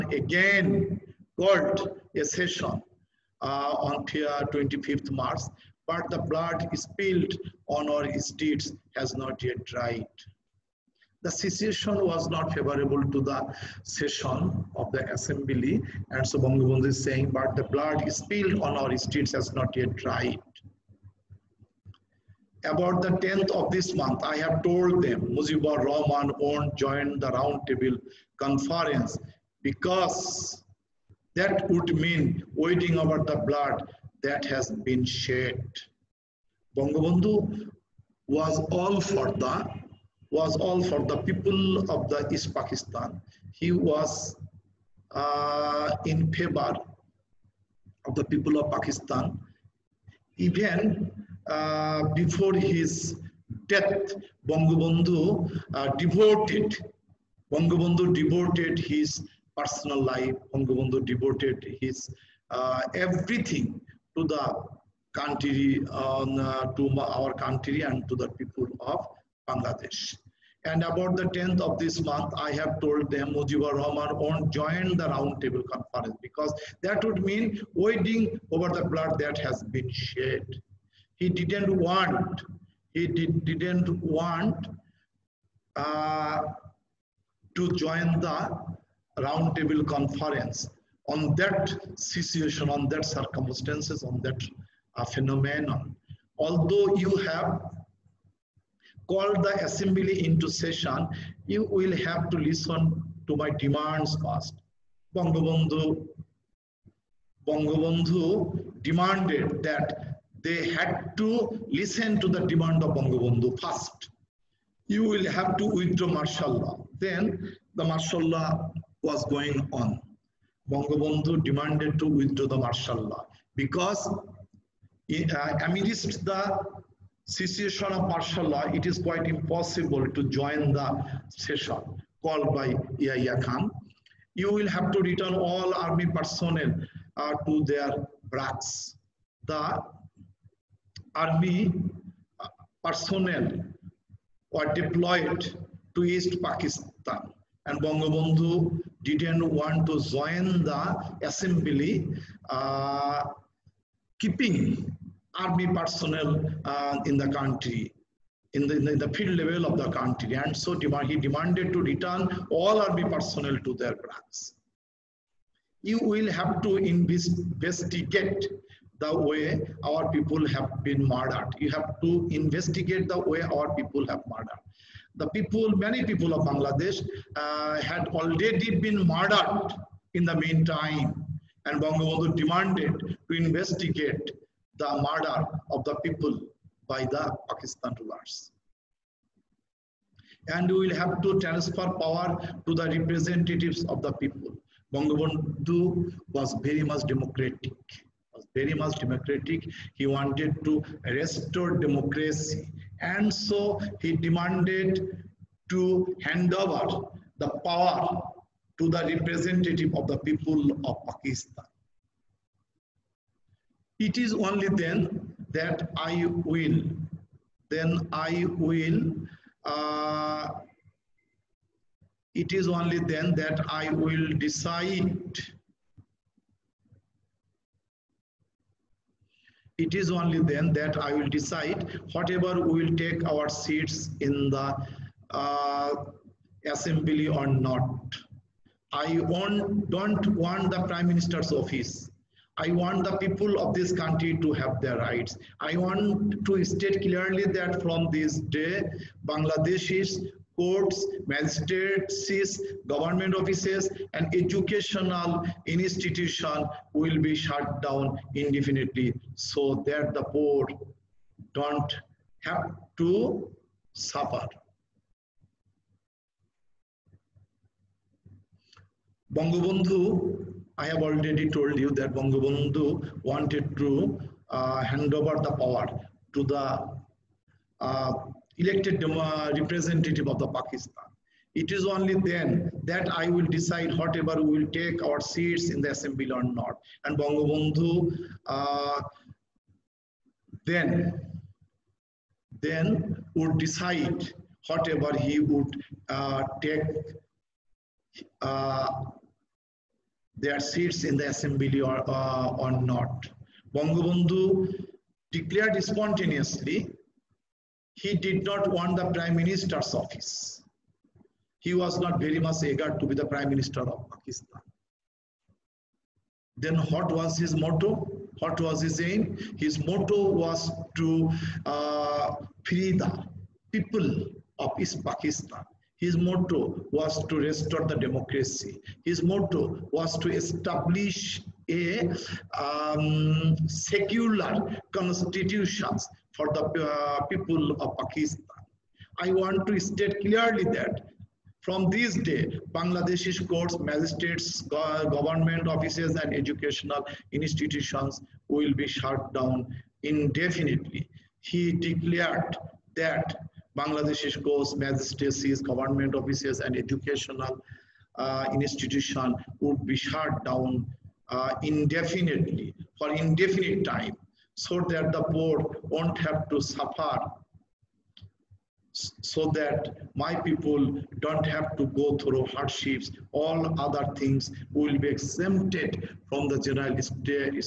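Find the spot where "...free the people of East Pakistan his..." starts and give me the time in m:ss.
5:22.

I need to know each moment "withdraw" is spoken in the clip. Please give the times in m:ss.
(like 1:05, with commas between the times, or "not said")
1:55, 2:02.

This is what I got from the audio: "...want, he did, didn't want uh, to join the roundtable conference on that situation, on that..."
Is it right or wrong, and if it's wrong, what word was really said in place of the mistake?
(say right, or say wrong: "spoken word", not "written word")
right.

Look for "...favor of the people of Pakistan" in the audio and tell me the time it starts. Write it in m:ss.
0:46.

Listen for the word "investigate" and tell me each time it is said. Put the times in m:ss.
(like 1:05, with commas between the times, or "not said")
2:46, 2:52, 3:03.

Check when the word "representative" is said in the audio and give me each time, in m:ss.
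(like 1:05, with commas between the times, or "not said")
3:12, 3:29, 4:39.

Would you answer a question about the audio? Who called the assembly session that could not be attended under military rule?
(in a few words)
Yaya Khan.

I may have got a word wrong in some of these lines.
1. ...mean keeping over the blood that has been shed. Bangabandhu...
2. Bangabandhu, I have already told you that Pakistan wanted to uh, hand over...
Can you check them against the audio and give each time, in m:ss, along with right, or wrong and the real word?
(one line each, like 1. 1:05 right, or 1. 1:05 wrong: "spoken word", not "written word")
1. 0:31 wrong: "waiting", not "keeping"
2. 4:29 wrong: "Bangabandhu", not "Pakistan".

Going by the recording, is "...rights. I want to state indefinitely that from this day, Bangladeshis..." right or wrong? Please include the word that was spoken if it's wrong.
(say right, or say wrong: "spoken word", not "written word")
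wrong: "clearly", not "indefinitely".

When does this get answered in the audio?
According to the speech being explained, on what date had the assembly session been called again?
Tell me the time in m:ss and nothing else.
0:04.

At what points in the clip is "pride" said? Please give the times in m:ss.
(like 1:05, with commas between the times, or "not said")
not said.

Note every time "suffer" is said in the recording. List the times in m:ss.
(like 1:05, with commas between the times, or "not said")
4:23, 6:06.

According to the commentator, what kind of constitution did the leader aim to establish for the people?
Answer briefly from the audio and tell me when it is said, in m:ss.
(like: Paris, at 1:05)
secular constitution, at 5:33.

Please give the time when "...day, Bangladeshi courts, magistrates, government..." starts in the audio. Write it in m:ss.
5:42.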